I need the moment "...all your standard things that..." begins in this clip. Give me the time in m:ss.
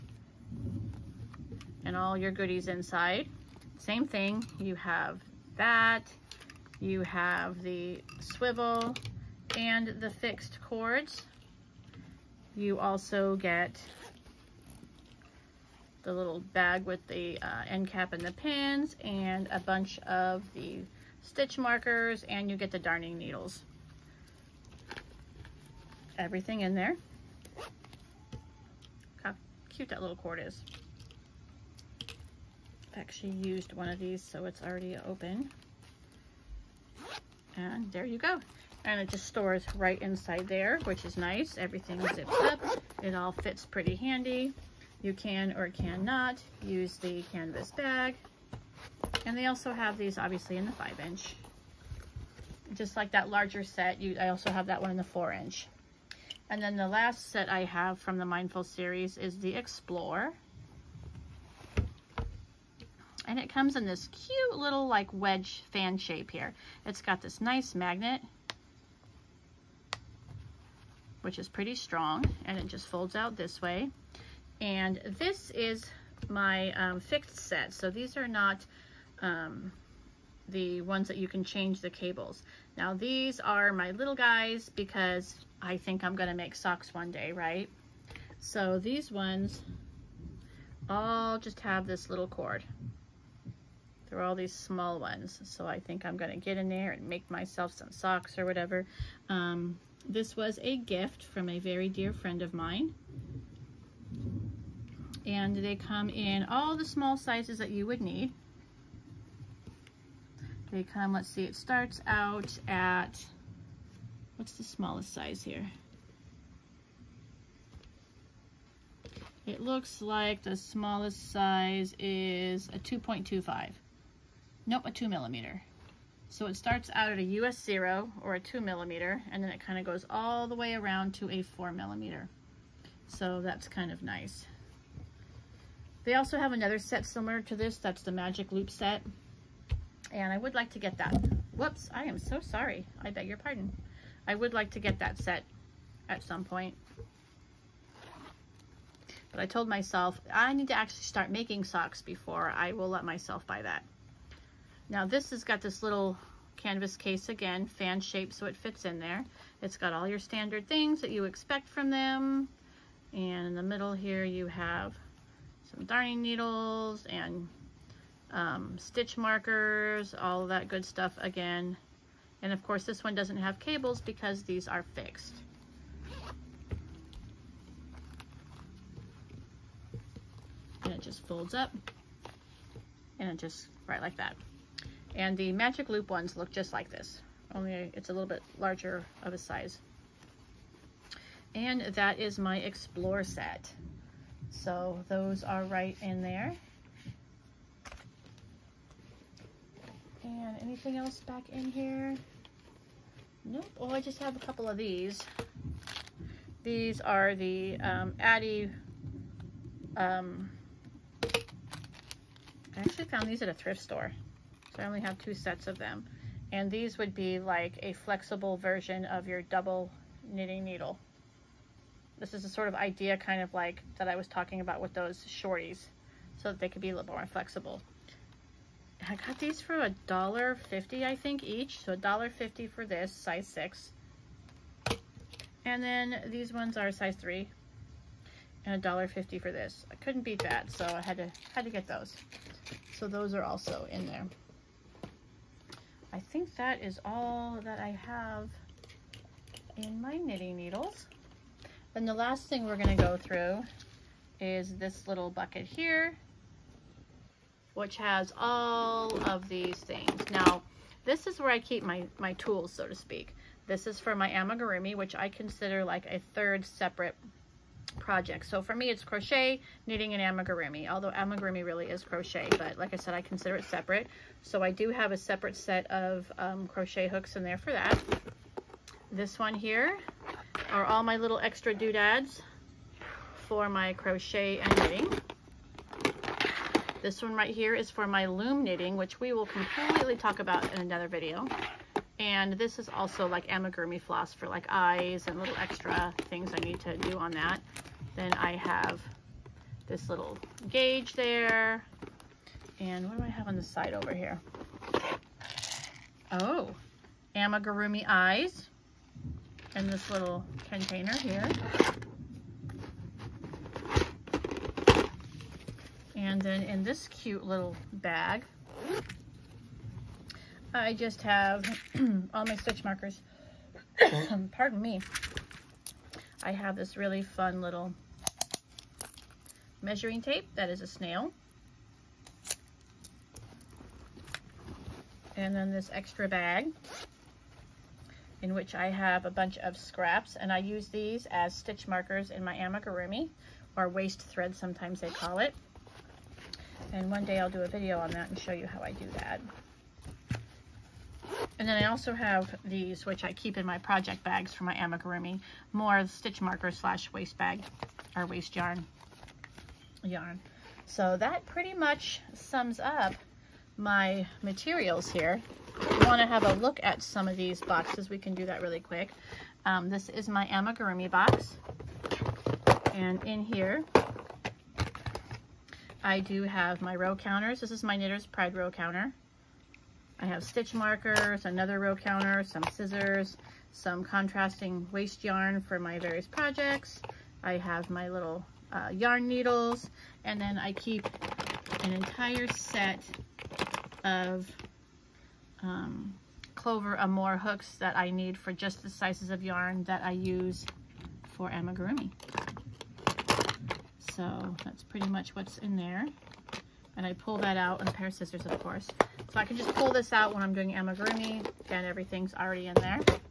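2:39.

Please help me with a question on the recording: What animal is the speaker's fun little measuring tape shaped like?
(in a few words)
A snail.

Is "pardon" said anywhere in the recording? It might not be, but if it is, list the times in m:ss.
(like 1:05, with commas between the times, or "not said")
2:23, 5:24.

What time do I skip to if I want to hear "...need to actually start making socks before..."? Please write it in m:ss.
2:30.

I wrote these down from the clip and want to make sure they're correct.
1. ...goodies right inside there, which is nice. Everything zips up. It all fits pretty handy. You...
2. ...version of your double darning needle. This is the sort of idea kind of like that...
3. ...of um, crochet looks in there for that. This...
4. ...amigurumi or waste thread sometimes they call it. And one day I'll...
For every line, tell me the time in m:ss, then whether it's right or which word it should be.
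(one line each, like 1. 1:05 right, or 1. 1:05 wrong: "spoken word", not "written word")
1. 0:39 wrong: "stores", not "goodies"
2. 3:38 wrong: "knitting", not "darning"
3. 4:35 wrong: "hooks", not "looks"
4. 5:42 right.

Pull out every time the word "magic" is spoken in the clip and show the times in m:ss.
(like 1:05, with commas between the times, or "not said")
2:18, 3:05.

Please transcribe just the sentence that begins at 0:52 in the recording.
Just like that larger set, you, I also have that one in the four inch.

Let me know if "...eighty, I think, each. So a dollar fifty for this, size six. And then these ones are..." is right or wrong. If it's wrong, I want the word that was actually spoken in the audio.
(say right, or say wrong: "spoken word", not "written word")
wrong: "fifty", not "eighty".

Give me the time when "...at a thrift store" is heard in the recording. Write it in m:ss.
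3:33.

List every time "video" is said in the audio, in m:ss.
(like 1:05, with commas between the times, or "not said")
4:51, 5:47.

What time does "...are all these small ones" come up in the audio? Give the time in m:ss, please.
1:34.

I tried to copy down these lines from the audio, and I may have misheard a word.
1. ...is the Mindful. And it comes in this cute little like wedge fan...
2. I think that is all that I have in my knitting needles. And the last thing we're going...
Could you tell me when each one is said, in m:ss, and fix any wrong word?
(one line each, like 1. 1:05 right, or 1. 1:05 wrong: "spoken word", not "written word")
1. 0:59 wrong: "Explore", not "Mindful"
2. 4:06 right.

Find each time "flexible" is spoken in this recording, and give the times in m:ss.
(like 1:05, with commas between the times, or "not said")
3:37, 3:47.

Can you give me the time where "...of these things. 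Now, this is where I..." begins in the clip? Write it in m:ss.
4:19.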